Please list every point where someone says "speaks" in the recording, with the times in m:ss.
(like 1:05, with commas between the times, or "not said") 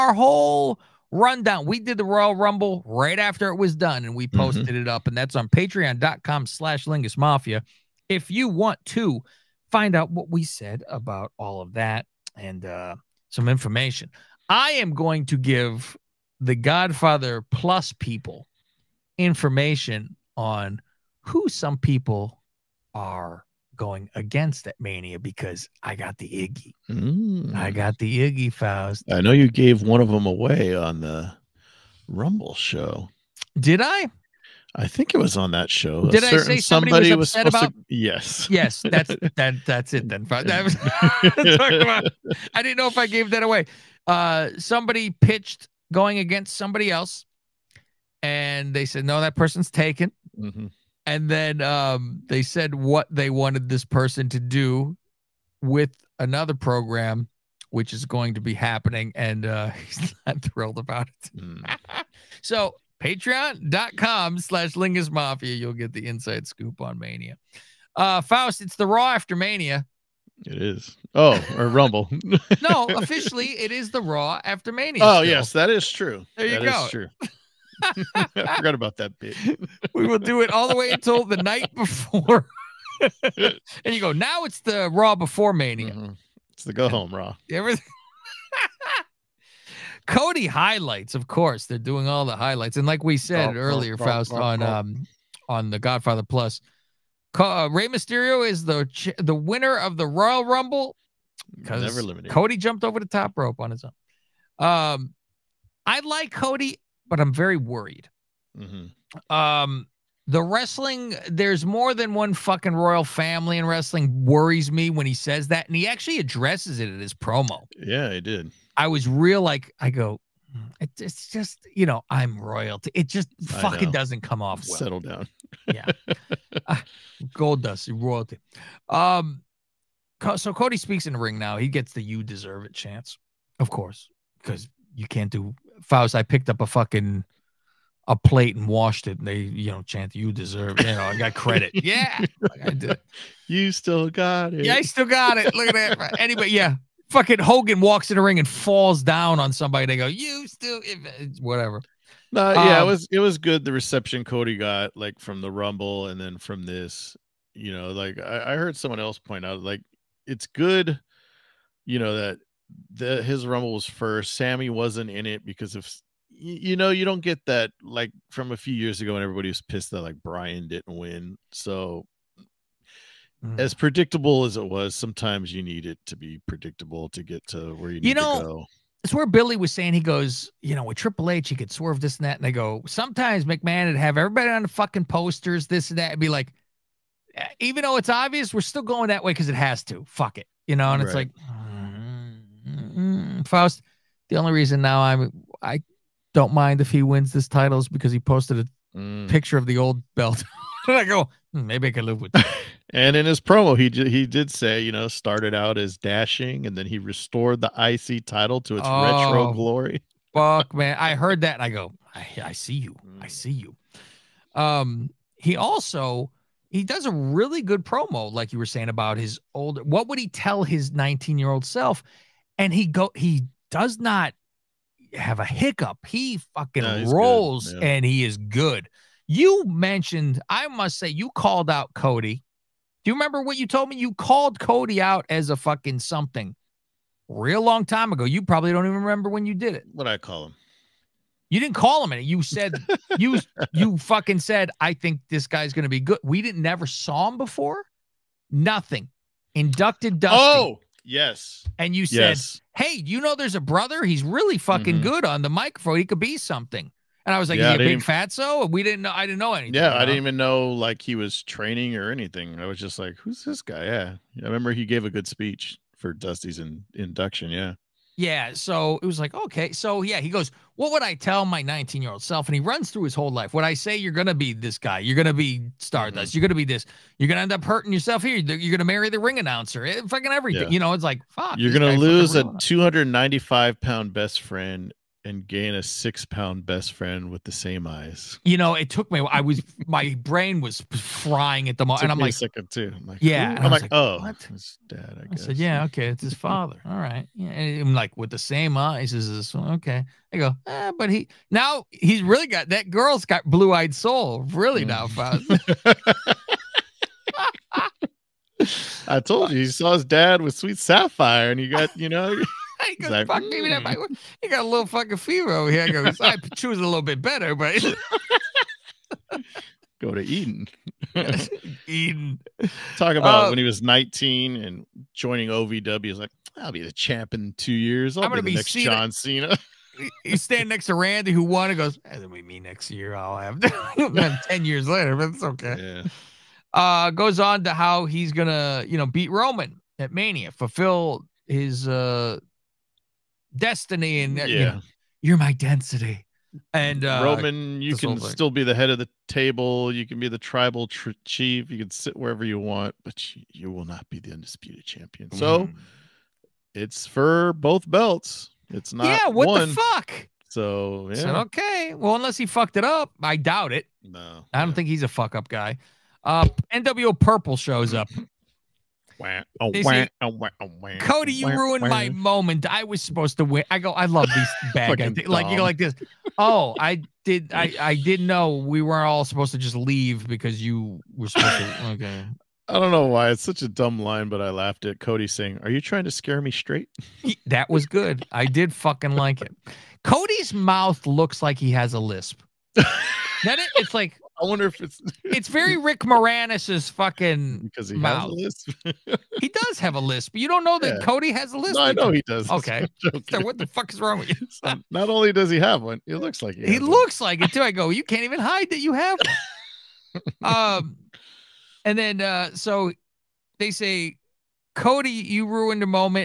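2:10.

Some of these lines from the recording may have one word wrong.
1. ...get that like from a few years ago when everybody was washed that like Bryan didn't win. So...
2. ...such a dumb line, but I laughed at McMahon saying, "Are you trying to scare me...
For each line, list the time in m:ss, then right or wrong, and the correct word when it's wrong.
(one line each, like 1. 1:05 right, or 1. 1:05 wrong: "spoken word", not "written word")
1. 2:47 wrong: "pissed", not "washed"
2. 6:23 wrong: "Cody", not "McMahon".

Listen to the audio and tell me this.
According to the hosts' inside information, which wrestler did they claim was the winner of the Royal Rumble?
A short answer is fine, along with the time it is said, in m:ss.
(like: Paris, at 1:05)
Rey Mysterio, at 1:37.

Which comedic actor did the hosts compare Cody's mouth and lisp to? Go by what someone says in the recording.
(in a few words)
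Rick Moranis.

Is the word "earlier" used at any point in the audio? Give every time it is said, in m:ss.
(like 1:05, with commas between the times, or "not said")
1:33.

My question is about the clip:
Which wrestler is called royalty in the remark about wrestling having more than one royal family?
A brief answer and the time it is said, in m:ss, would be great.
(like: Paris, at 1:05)
Goldust, at 2:07.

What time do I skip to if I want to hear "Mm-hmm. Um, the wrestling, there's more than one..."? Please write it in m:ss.
1:48.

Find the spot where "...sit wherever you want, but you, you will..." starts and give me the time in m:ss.
5:51.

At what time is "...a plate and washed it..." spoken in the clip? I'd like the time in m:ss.
2:18.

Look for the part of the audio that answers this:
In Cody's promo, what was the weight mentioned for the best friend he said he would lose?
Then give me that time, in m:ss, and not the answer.
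4:42.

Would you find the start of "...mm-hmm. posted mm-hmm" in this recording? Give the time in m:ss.
0:04.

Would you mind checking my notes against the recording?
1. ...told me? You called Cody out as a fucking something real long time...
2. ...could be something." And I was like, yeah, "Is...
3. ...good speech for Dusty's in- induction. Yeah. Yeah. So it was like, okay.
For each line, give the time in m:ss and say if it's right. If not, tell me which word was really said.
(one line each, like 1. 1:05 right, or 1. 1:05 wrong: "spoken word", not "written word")
1. 3:53 right
2. 4:16 right
3. 4:25 right.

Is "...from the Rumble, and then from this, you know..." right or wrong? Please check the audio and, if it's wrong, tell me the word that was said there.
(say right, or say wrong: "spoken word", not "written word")
right.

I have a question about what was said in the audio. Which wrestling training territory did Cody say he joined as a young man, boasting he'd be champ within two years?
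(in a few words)
OVW.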